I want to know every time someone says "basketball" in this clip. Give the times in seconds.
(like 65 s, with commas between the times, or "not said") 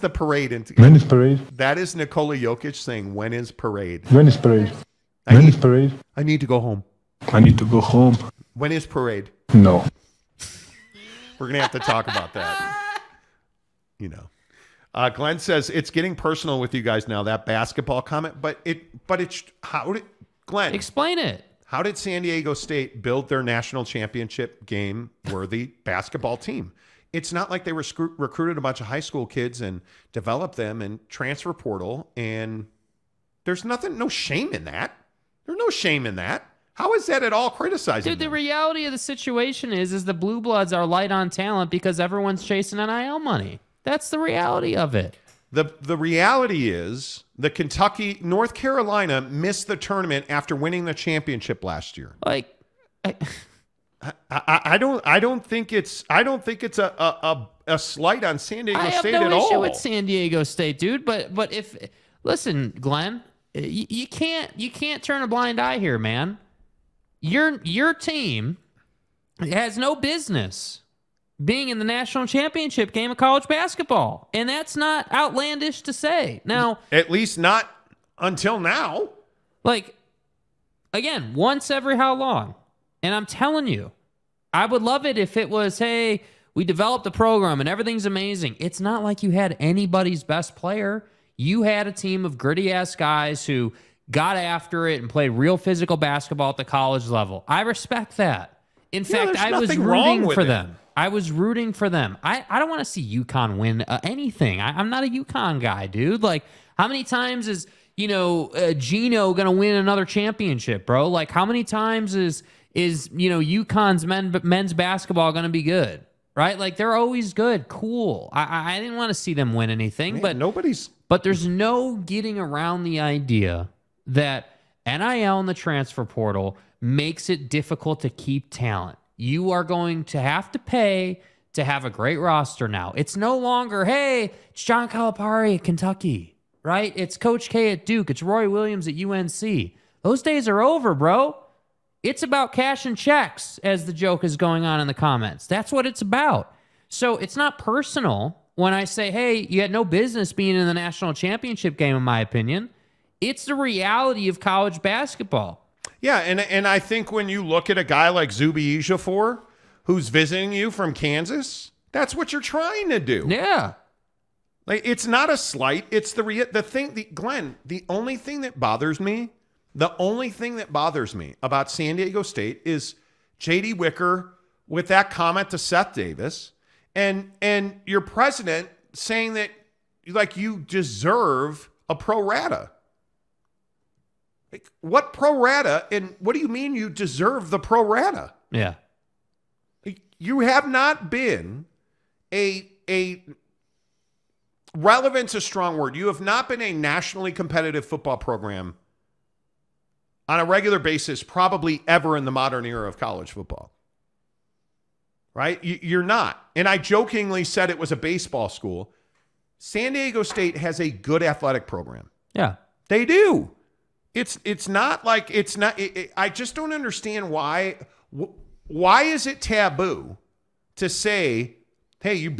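17 s, 25 s, 73 s, 95 s, 114 s, 154 s.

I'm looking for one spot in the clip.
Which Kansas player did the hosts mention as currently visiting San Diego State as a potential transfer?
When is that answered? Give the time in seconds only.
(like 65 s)
158 s.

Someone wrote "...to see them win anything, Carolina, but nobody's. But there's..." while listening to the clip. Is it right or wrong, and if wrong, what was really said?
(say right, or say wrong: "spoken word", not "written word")
wrong: "Man", not "Carolina".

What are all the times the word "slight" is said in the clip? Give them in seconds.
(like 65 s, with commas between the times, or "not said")
57 s, 165 s.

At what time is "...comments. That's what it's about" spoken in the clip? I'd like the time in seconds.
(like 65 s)
144 s.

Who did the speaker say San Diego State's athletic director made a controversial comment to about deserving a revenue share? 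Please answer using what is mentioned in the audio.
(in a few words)
Seth Davis.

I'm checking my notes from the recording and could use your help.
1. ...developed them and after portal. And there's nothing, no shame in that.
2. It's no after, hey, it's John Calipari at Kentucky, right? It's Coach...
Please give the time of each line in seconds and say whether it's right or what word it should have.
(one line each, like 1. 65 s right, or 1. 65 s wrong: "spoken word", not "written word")
1. 30 s wrong: "transfer", not "after"
2. 132 s wrong: "longer", not "after".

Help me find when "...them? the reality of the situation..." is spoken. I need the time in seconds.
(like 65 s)
38 s.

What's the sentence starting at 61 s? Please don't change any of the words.
But but if listen, Glenn, you, you can't you can't turn a blind eye here, man.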